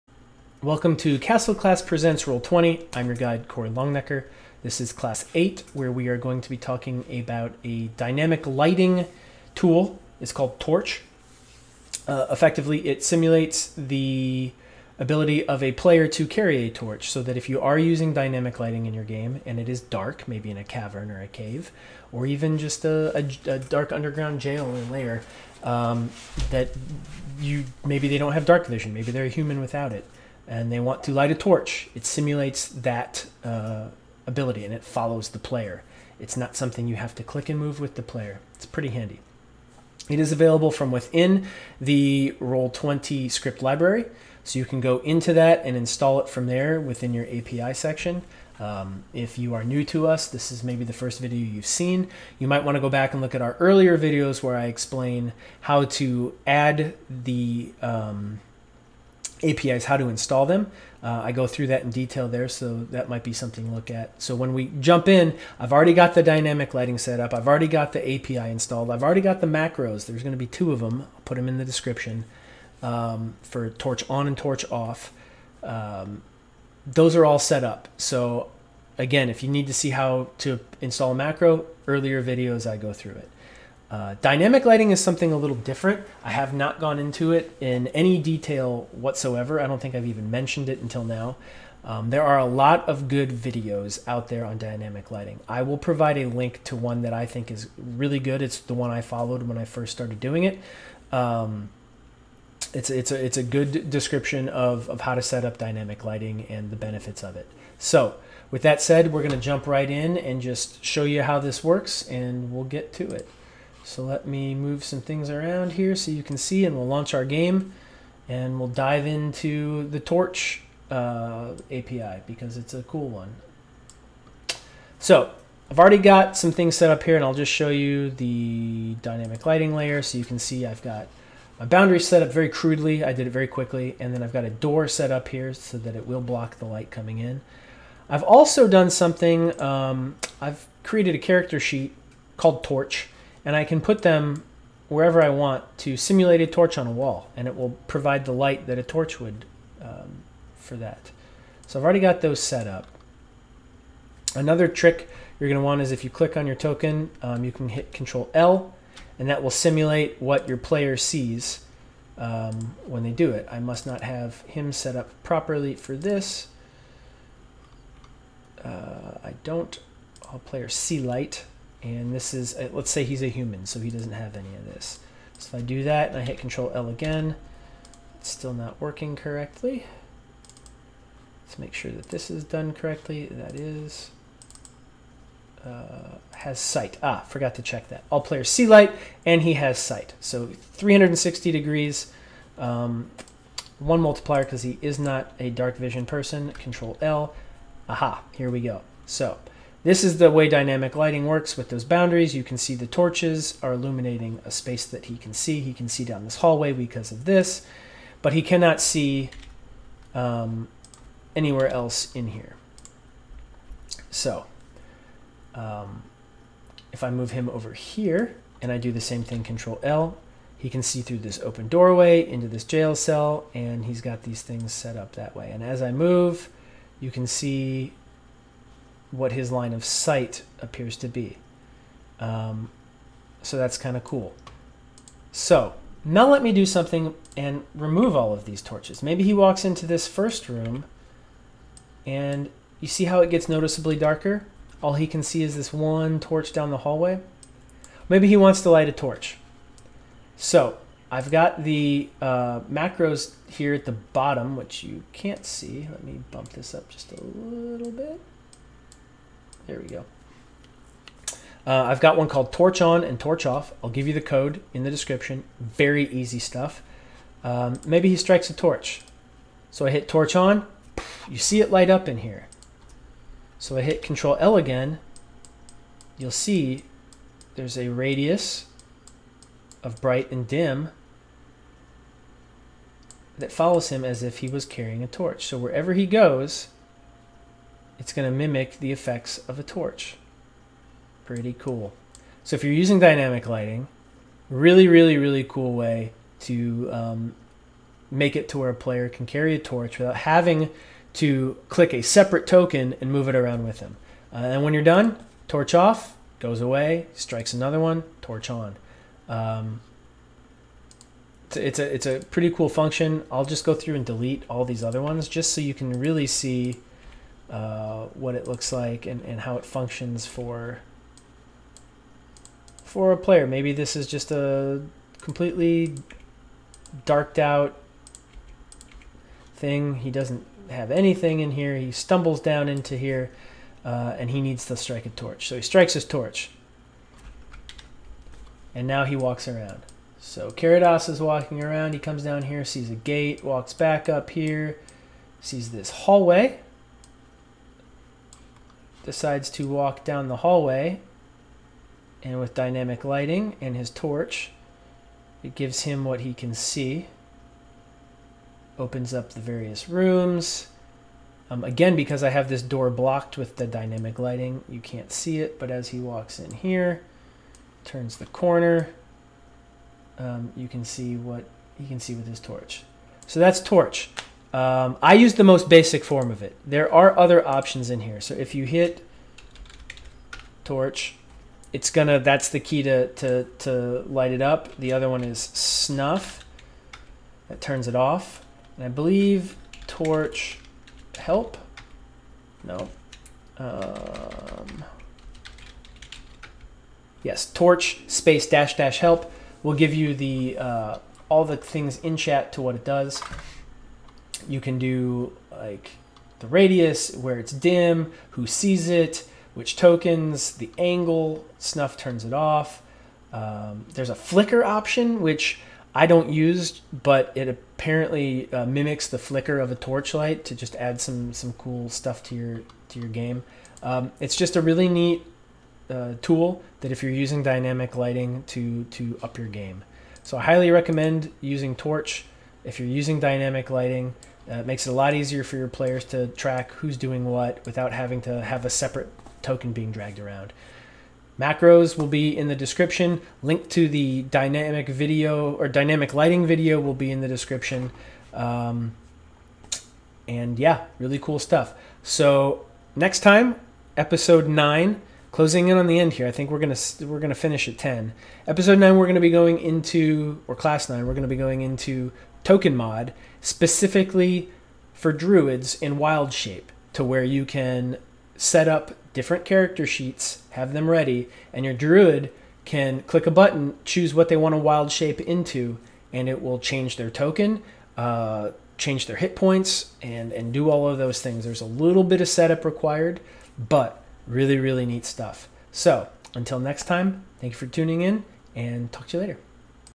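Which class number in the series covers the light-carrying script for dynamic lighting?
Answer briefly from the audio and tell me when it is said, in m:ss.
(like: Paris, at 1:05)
8, at 0:04.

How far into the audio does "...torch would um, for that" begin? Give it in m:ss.
2:28.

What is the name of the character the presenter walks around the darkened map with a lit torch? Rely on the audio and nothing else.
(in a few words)
Carados.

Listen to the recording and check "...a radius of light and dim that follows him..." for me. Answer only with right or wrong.
wrong.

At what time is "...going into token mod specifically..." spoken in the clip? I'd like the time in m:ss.
7:41.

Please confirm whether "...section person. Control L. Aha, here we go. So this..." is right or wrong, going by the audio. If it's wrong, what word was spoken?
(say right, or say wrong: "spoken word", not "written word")
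wrong: "vision", not "section".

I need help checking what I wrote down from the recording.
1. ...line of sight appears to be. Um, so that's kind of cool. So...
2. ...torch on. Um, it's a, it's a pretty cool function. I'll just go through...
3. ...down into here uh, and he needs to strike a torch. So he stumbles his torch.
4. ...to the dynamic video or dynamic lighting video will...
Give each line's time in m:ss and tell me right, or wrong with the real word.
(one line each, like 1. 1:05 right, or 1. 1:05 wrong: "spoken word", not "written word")
1. 3:49 right
2. 5:08 right
3. 5:32 wrong: "strikes", not "stumbles"
4. 7:23 right.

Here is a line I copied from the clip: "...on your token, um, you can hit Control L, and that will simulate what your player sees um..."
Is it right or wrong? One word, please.
right.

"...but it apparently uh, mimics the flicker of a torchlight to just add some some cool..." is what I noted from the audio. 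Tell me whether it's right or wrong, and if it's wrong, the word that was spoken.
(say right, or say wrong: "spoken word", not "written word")
right.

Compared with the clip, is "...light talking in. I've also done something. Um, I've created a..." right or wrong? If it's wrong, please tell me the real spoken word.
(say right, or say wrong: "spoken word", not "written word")
wrong: "coming", not "talking".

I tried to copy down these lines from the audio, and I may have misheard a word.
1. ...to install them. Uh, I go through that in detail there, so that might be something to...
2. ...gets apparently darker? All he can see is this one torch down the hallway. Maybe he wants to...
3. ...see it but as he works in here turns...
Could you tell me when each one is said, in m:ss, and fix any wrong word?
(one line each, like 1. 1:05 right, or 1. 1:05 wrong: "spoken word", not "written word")
1. 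0:59 right
2. 4:03 wrong: "noticeably", not "apparently"
3. 6:05 wrong: "walks", not "works".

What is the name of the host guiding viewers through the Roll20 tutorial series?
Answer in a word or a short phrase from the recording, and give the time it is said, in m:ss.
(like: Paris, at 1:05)
Corey Longnecker, at 0:03.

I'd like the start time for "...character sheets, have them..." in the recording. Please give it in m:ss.
7:49.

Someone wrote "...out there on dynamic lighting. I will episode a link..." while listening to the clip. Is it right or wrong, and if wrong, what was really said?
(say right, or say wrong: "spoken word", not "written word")
wrong: "provide", not "episode".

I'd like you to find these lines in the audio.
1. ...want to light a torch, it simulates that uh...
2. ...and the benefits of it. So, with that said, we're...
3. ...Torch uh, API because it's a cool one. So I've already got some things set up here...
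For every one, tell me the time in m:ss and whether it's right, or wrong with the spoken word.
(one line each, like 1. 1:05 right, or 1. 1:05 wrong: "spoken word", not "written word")
1. 0:30 right
2. 1:46 right
3. 1:59 right.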